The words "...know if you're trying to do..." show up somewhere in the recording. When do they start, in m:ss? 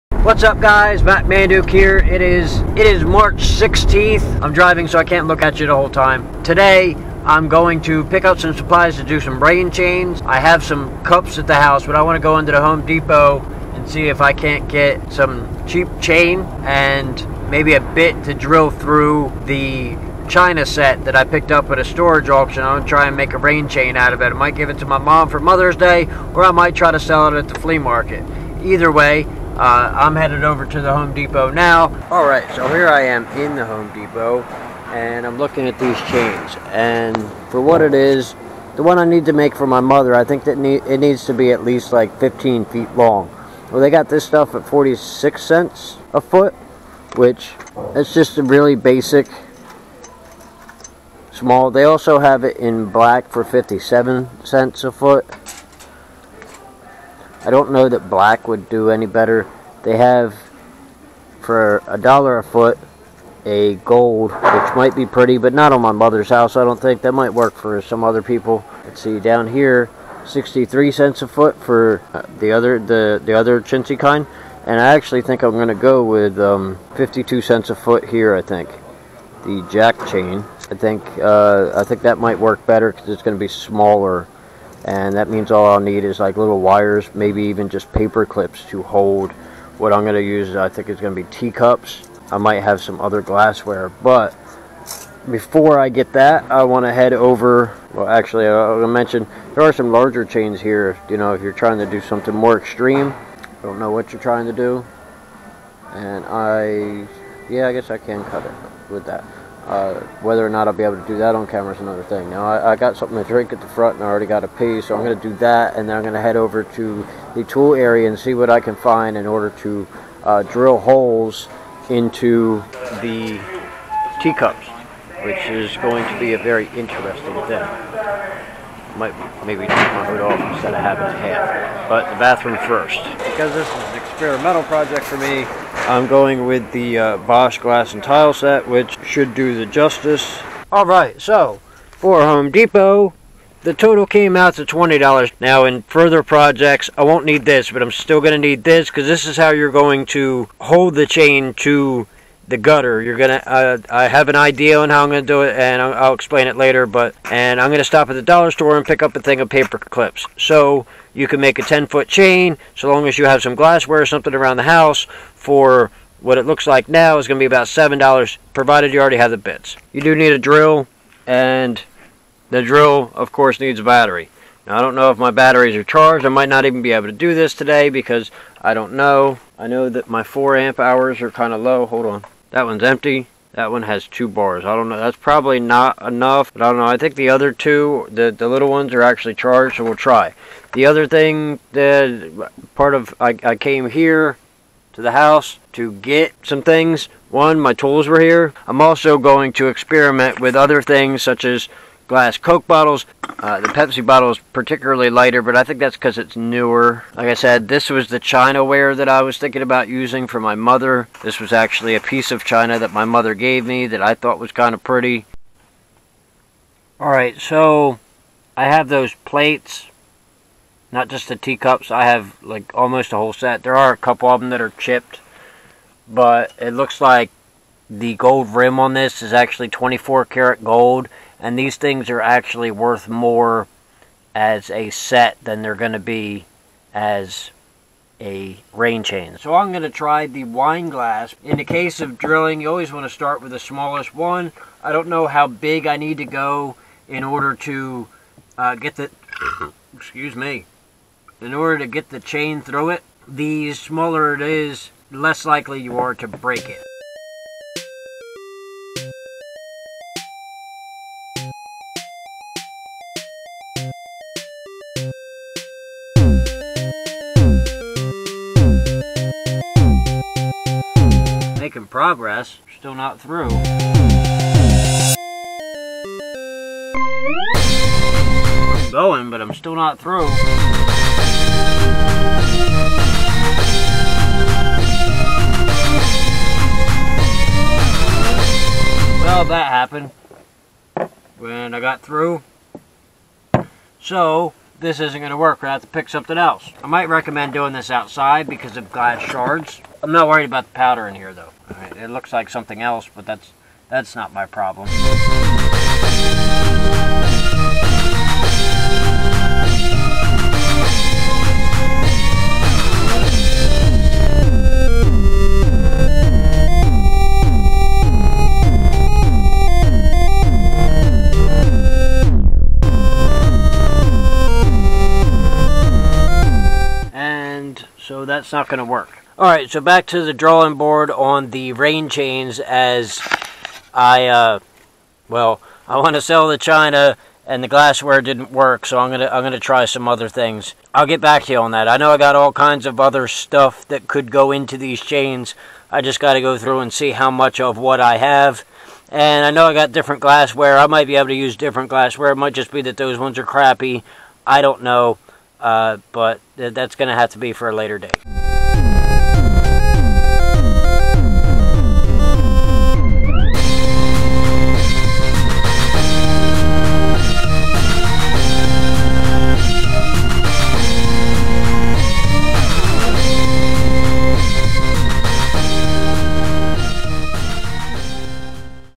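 1:41.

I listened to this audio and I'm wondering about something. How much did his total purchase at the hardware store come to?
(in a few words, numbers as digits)
$20.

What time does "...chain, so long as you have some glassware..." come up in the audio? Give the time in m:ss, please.
2:42.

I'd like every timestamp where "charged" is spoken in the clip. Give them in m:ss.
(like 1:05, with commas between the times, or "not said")
2:55, 3:09.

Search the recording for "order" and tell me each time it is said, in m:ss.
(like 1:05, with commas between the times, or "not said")
1:59, 4:07, 4:11.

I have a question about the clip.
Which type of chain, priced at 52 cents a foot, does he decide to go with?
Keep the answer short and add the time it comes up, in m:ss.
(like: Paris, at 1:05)
jack chain, at 1:19.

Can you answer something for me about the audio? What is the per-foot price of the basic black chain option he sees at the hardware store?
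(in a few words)
57 cents.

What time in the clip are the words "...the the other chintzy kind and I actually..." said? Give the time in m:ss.
1:12.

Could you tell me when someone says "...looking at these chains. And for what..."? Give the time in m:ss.
0:35.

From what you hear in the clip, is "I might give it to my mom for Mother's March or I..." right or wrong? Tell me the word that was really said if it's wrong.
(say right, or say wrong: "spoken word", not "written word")
wrong: "Day", not "March".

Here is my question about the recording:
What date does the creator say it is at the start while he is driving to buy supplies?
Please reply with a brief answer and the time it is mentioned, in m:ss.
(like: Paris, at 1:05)
March 16th, at 0:03.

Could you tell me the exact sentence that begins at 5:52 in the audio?
It might just be that those ones are crappy.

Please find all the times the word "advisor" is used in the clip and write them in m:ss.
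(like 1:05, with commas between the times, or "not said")
not said.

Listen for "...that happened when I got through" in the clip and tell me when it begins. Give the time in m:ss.
4:49.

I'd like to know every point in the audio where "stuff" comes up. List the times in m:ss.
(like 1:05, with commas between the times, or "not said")
0:44, 5:43.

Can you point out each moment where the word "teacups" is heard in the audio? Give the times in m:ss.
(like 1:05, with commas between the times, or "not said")
1:31, 2:04, 3:41.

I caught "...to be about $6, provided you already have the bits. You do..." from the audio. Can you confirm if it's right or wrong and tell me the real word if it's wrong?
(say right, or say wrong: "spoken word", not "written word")
wrong: "7", not "6".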